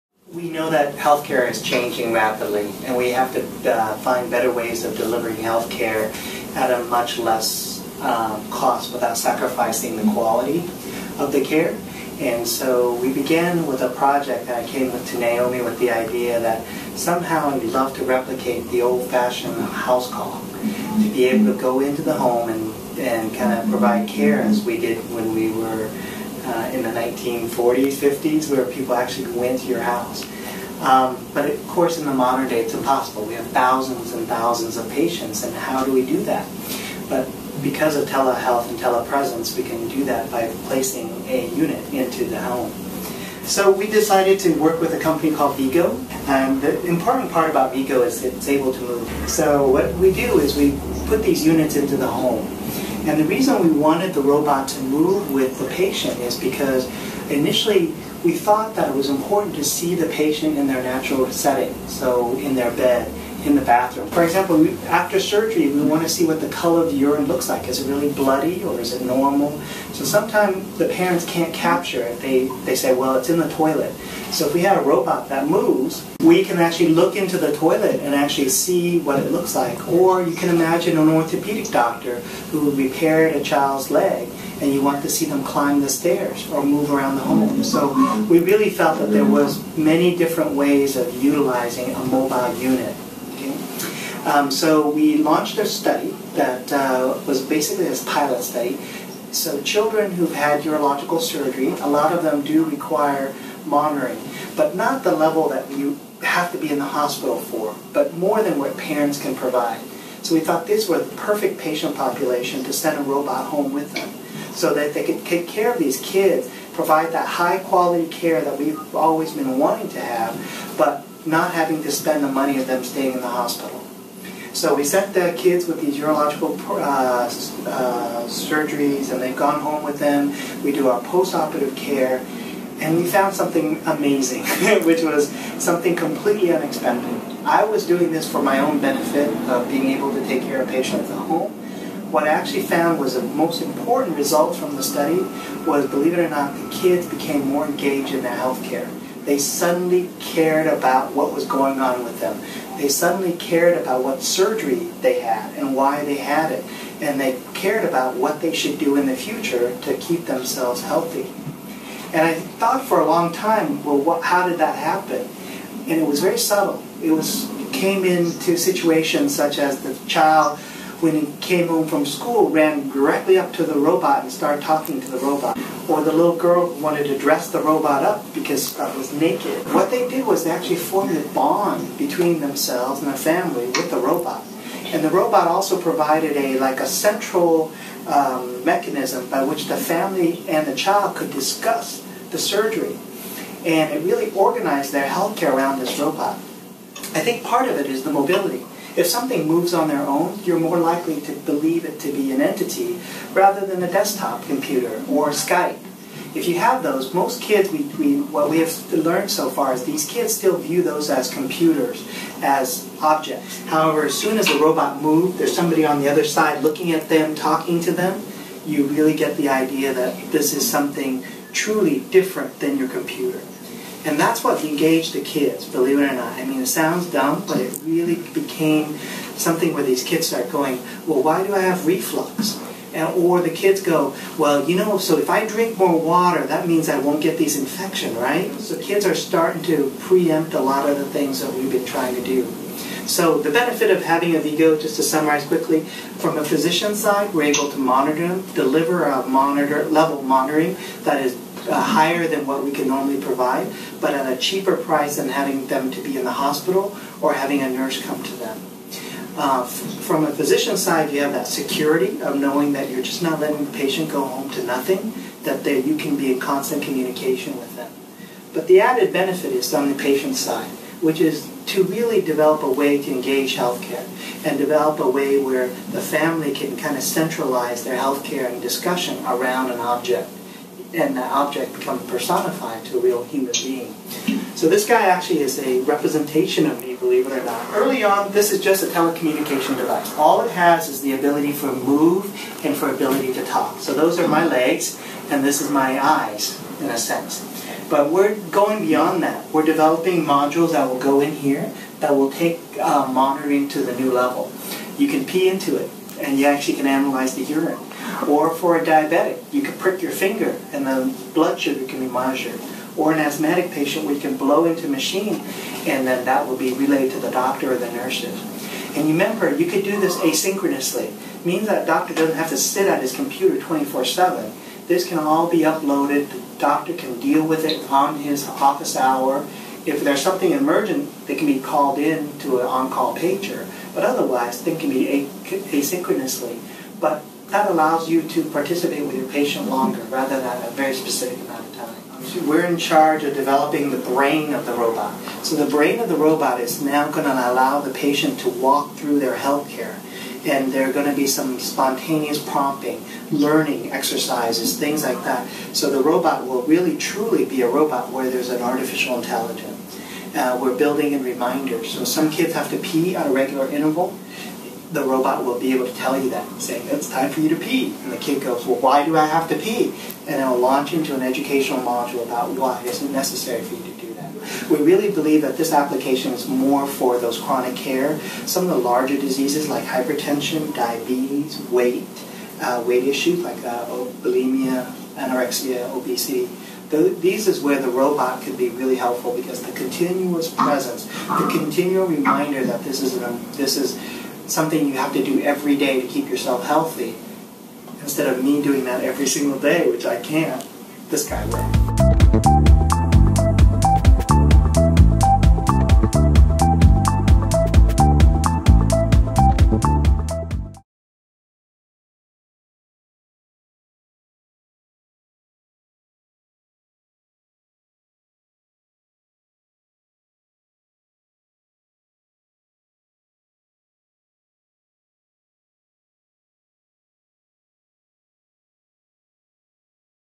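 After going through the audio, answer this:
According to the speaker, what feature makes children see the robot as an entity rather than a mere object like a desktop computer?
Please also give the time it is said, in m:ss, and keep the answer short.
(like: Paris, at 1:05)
Mobility, at 3:18.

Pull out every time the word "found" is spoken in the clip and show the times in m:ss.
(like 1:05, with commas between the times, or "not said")
2:13, 2:22.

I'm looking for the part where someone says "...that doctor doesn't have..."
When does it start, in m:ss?
5:21.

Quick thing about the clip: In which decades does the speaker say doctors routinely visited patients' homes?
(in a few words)
1940s, 50s.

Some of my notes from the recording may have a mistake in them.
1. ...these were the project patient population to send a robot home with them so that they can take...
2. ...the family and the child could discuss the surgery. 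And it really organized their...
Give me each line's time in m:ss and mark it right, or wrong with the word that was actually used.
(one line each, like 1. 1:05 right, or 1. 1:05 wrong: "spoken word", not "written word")
1. 1:50 wrong: "perfect", not "project"
2. 3:09 right.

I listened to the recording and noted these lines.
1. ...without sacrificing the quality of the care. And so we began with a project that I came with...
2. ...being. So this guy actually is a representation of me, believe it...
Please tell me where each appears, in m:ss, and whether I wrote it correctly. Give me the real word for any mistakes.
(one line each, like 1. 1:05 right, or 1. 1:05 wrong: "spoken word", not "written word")
1. 0:08 right
2. 4:43 right.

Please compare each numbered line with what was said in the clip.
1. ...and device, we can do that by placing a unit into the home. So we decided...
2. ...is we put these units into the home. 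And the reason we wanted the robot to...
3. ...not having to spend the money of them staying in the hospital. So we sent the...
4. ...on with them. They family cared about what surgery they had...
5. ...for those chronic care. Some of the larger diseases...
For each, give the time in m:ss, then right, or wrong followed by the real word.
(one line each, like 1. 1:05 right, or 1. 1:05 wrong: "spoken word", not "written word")
1. 0:38 wrong: "telepresence", not "device"
2. 0:50 right
3. 2:01 right
4. 2:31 wrong: "suddenly", not "family"
5. 6:16 right.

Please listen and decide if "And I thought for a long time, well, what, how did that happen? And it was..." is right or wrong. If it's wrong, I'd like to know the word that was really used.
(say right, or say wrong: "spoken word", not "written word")
right.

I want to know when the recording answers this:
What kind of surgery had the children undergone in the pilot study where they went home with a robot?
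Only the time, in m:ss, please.
1:40.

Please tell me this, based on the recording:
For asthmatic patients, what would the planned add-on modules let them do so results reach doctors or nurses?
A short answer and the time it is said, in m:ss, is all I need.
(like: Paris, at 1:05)
Blow into a machine, at 5:14.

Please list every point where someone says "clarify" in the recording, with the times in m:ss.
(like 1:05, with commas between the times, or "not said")
not said.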